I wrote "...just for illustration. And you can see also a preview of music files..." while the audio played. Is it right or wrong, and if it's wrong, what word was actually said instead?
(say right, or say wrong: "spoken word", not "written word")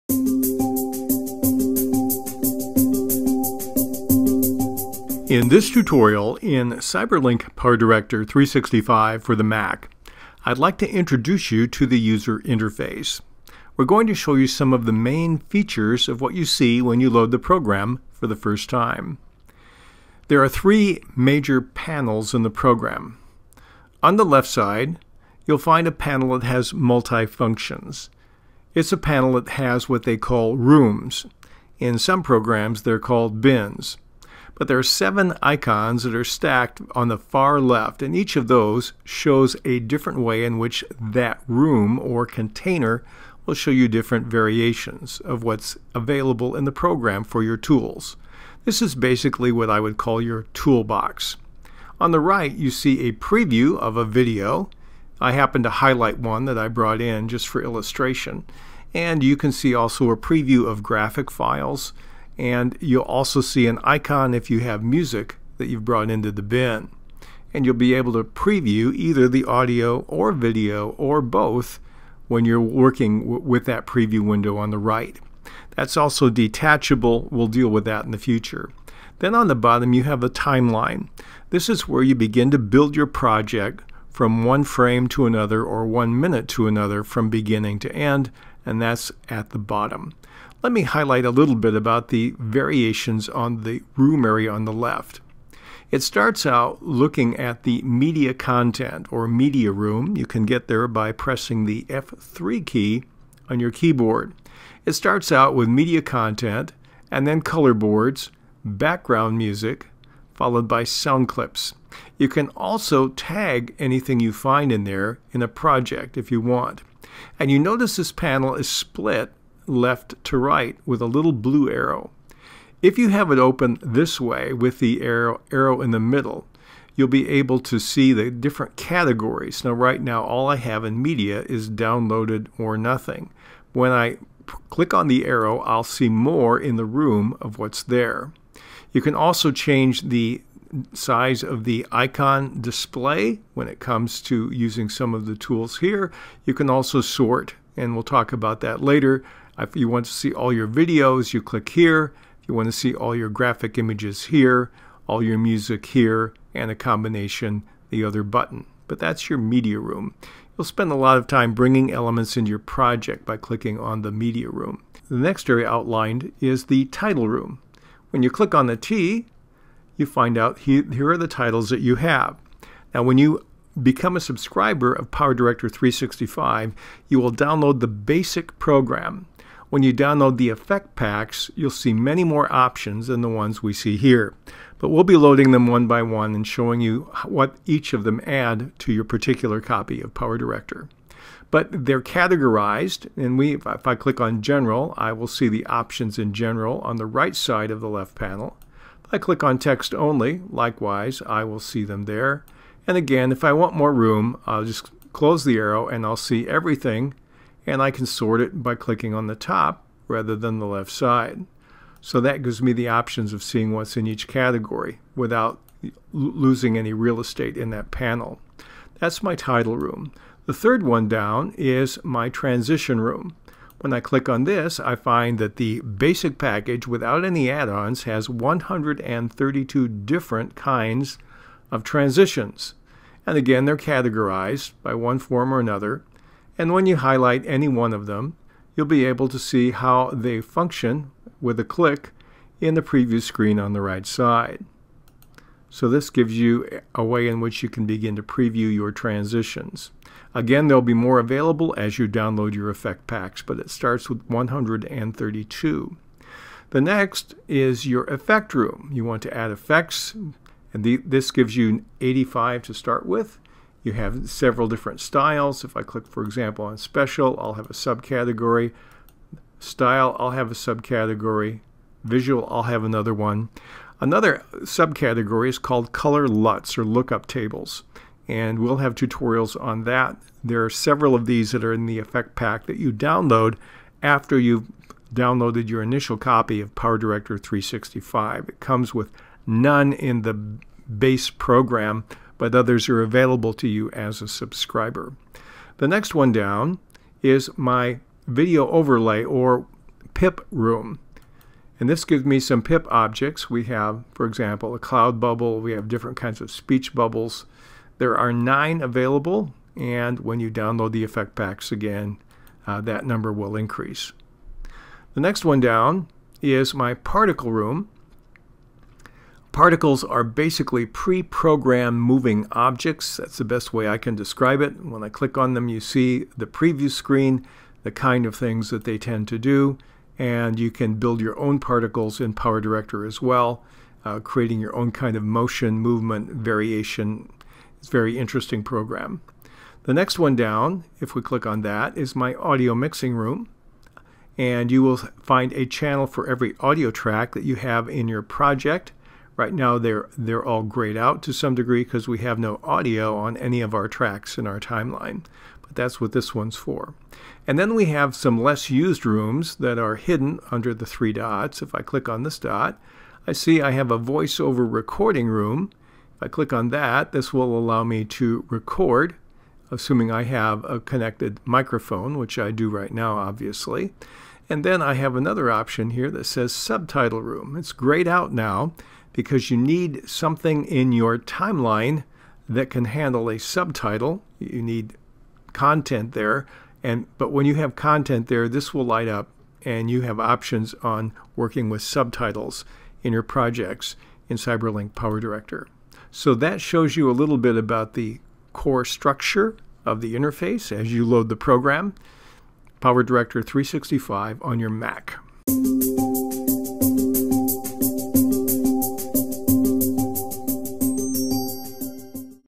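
wrong: "graphic", not "music".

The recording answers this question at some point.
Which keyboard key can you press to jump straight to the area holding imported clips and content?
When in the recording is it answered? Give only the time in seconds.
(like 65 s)
101 s.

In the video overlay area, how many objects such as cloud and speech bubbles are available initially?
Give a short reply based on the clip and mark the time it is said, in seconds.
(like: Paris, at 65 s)
9, at 308 s.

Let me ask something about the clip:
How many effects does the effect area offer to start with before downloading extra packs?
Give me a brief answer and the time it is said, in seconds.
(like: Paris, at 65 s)
85, at 262 s.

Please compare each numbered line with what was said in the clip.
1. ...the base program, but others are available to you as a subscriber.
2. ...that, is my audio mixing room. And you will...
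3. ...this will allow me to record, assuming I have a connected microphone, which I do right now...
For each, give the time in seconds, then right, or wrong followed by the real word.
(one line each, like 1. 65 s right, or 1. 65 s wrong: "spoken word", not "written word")
1. 290 s right
2. 341 s right
3. 367 s right.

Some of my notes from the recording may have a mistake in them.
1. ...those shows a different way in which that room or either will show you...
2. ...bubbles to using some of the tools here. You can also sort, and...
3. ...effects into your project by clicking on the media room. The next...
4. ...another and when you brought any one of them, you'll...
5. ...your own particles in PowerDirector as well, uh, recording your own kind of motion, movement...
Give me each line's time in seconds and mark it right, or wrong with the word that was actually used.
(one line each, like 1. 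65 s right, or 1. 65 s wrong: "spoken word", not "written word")
1. 38 s wrong: "container", not "either"
2. 143 s wrong: "comes", not "bubbles"
3. 161 s wrong: "elements", not "effects"
4. 235 s wrong: "highlight", not "brought"
5. 331 s wrong: "creating", not "recording".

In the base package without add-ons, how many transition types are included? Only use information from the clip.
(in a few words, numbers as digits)
132.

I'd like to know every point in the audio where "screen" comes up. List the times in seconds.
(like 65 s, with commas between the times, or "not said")
243 s, 326 s.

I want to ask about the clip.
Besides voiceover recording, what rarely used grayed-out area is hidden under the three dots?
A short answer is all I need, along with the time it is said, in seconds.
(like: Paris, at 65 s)
subtitle room, at 376 s.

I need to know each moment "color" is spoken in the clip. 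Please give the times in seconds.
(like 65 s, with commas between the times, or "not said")
107 s, 275 s.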